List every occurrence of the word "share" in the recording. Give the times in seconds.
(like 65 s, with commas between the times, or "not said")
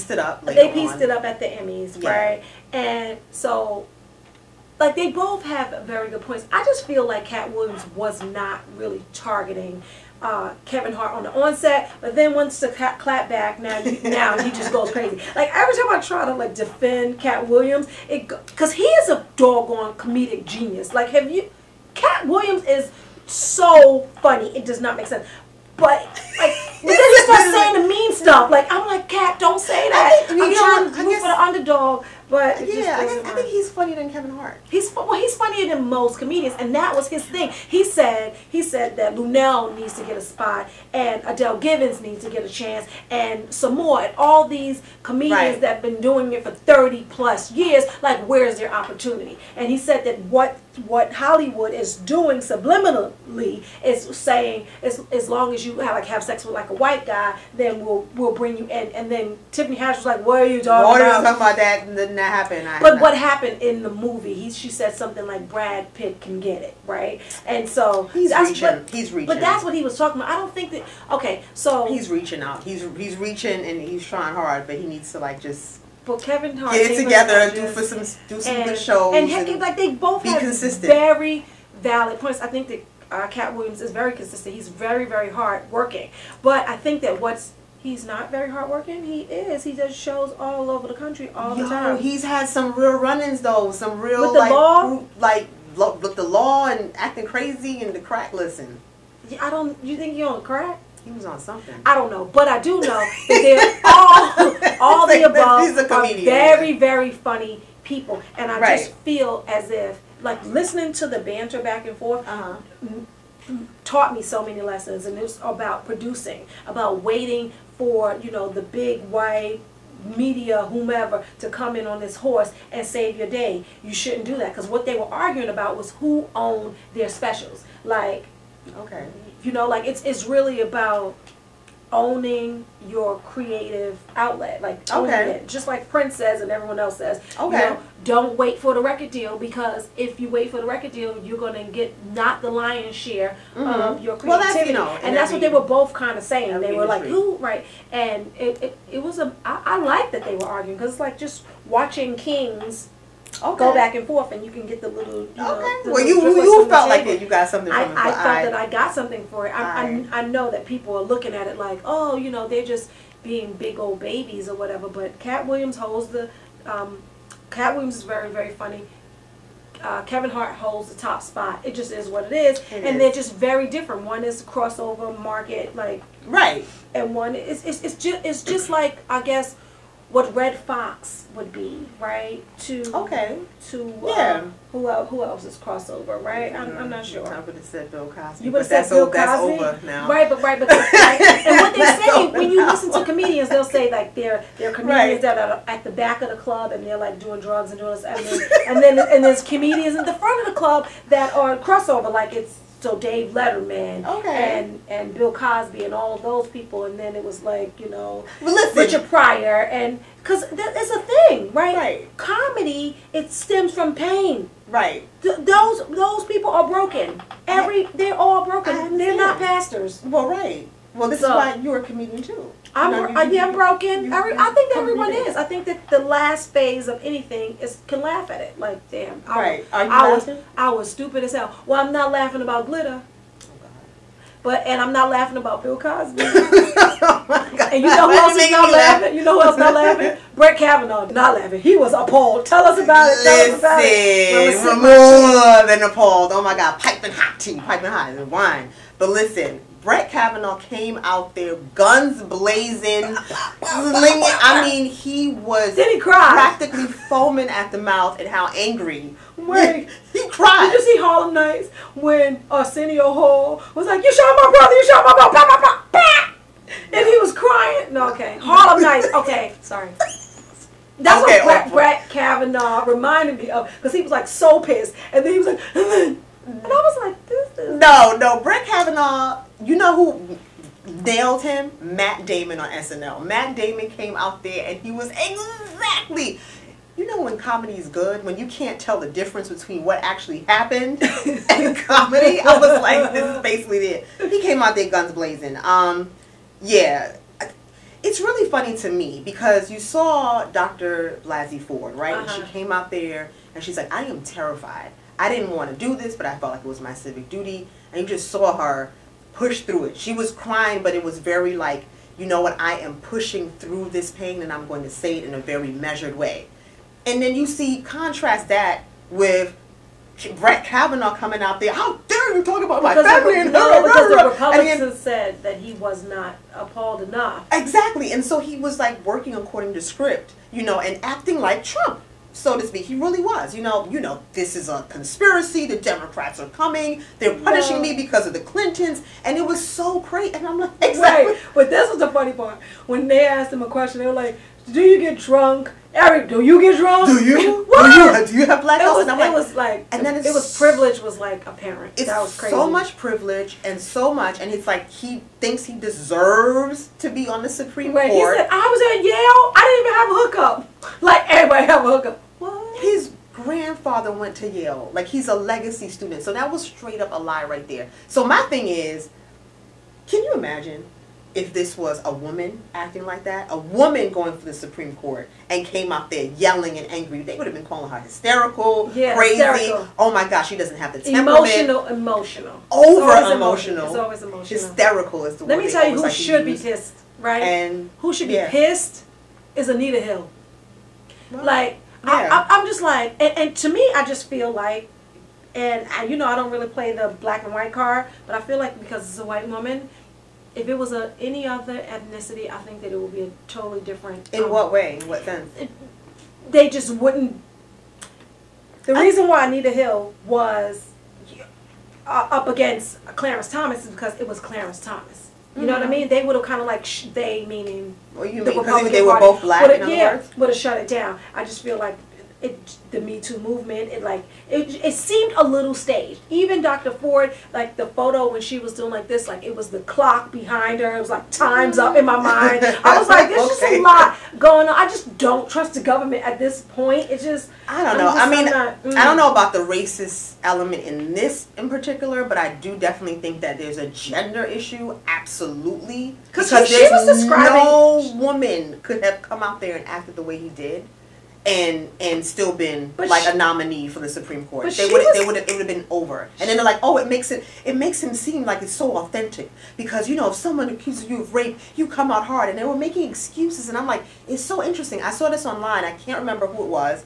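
142 s.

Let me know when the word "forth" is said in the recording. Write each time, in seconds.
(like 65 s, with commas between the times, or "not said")
111 s, 154 s.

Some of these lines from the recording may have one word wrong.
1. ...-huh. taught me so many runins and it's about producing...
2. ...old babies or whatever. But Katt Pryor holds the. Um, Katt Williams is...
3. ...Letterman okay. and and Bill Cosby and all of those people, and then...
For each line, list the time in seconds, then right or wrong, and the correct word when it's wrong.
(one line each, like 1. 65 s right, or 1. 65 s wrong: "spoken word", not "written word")
1. 112 s wrong: "lessons", not "runins"
2. 163 s wrong: "Williams", not "Pryor"
3. 203 s right.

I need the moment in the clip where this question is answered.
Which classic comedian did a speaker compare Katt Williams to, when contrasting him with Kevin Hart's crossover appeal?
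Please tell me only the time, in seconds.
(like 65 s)
180 s.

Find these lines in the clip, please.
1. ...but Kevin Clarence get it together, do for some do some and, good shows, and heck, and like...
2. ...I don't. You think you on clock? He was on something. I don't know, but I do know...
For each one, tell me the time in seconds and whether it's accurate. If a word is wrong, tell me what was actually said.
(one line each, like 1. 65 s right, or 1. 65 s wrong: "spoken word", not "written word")
1. 76 s wrong: "Hart", not "Clarence"
2. 99 s wrong: "crack", not "clock".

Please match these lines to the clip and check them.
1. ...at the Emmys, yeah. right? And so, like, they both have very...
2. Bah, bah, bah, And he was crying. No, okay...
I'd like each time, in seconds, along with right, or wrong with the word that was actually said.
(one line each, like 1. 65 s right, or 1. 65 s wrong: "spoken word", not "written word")
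1. 1 s right
2. 265 s right.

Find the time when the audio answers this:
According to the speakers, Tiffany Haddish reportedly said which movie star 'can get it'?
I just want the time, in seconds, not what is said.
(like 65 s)
65 s.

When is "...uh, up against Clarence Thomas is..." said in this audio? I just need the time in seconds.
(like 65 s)
411 s.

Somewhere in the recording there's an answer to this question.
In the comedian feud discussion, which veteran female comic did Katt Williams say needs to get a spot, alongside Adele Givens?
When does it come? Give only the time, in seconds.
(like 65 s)
39 s.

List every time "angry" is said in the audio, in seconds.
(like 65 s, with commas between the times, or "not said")
258 s, 376 s.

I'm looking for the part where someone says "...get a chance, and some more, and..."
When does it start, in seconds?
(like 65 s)
42 s.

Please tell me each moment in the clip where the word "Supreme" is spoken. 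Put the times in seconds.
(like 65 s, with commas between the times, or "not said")
357 s, 374 s, 454 s.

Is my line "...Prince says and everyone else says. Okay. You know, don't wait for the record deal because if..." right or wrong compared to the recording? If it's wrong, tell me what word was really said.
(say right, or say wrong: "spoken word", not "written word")
right.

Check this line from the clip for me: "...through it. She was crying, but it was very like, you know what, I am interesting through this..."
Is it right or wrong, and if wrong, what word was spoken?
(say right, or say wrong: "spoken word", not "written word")
wrong: "pushing", not "interesting".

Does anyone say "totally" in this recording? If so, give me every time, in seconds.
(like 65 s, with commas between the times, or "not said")
403 s.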